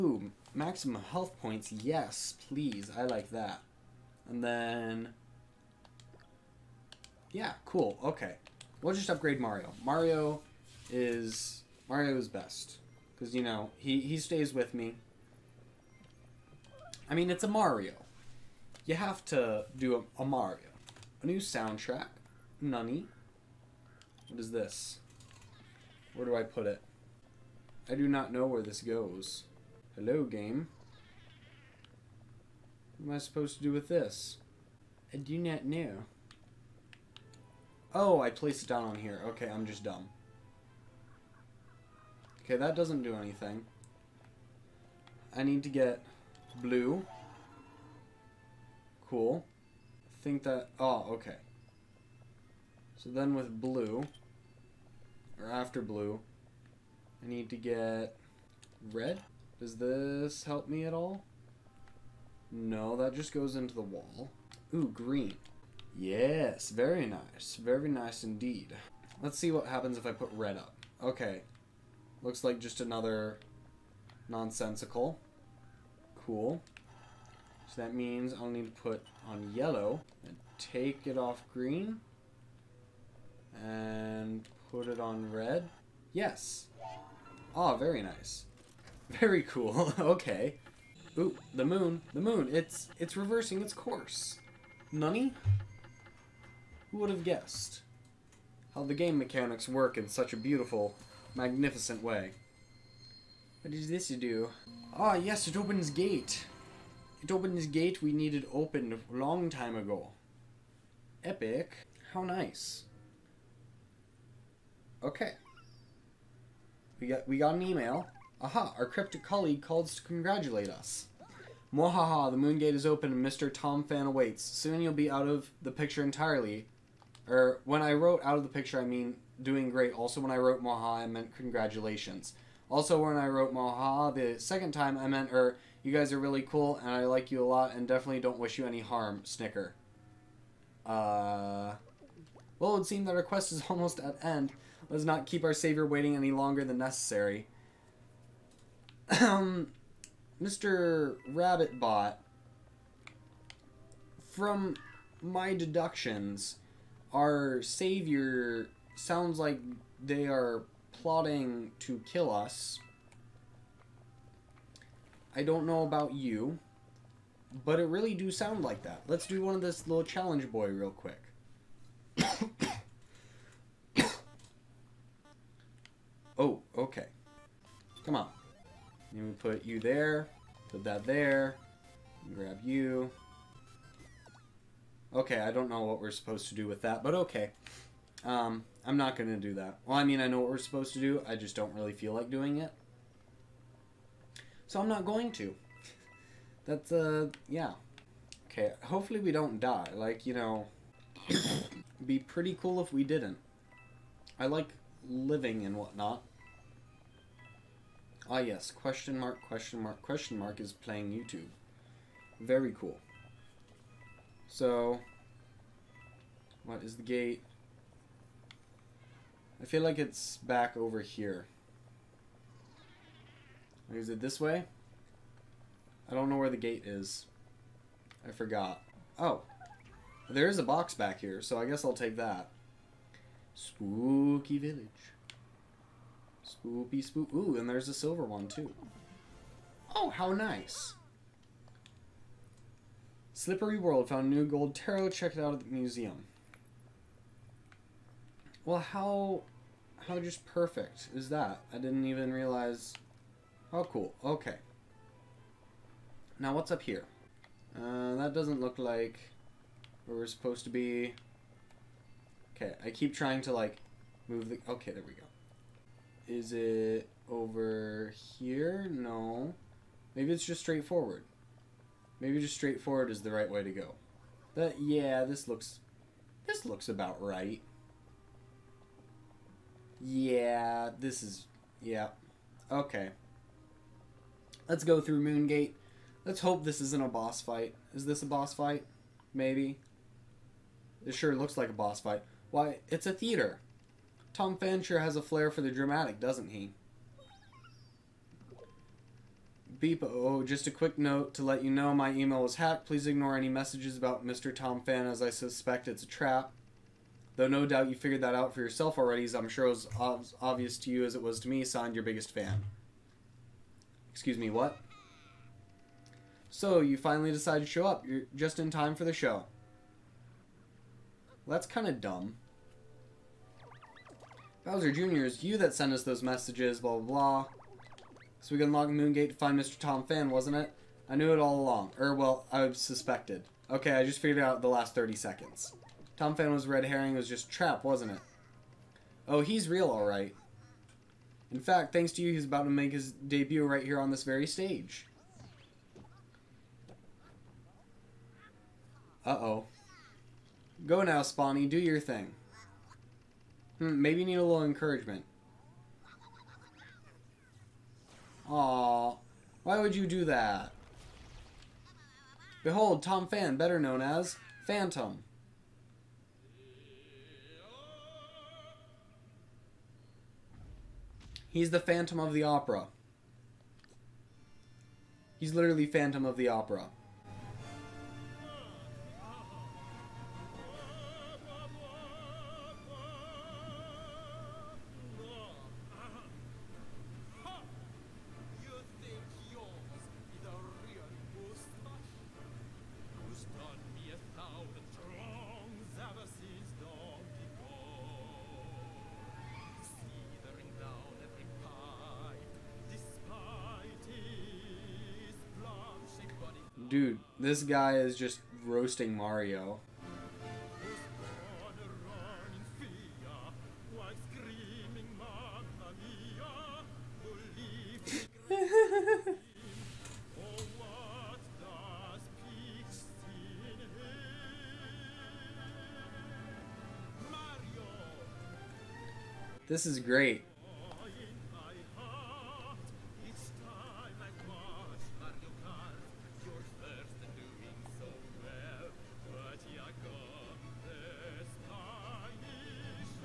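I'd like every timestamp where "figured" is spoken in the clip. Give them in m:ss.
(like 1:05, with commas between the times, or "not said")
5:07, 5:34.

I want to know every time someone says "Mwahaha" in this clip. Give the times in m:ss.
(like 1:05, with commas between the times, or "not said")
2:01.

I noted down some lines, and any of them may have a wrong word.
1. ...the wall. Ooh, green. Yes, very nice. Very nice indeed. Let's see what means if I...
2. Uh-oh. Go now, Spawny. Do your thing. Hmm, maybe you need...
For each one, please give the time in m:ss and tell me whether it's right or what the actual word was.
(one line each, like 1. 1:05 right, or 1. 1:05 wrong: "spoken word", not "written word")
1. 1:03 wrong: "happens", not "means"
2. 5:49 right.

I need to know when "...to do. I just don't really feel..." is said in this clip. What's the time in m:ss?
3:10.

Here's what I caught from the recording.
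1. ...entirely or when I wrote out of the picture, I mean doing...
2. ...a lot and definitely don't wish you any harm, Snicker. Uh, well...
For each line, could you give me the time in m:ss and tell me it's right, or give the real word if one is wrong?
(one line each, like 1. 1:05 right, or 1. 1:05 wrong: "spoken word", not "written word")
1. 2:06 right
2. 2:17 right.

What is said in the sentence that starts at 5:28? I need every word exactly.
So we can unlock Moongate to find Mr.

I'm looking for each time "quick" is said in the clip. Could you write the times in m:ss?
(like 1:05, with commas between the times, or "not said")
2:50, 5:00.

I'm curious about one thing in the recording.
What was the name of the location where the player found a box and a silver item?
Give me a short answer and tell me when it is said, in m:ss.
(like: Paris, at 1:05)
Spooky village, at 3:53.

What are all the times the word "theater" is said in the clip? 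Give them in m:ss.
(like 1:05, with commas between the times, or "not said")
4:53.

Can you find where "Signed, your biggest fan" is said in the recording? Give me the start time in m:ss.
5:11.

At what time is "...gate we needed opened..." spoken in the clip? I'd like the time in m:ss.
1:47.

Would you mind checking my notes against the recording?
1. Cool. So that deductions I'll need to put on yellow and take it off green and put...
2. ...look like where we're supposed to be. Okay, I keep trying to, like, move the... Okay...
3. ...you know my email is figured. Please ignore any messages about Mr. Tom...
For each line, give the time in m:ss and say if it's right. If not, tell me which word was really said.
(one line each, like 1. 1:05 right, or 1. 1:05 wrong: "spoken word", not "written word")
1. 1:16 wrong: "means", not "deductions"
2. 4:18 right
3. 5:01 wrong: "hacked", not "figured".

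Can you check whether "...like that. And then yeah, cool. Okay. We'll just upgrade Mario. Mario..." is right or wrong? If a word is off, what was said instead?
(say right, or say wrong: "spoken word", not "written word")
right.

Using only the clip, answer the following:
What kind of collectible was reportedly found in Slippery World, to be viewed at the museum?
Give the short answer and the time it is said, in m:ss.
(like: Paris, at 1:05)
Gold tarot, at 4:04.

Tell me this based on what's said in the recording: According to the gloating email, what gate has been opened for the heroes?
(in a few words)
The moon gate.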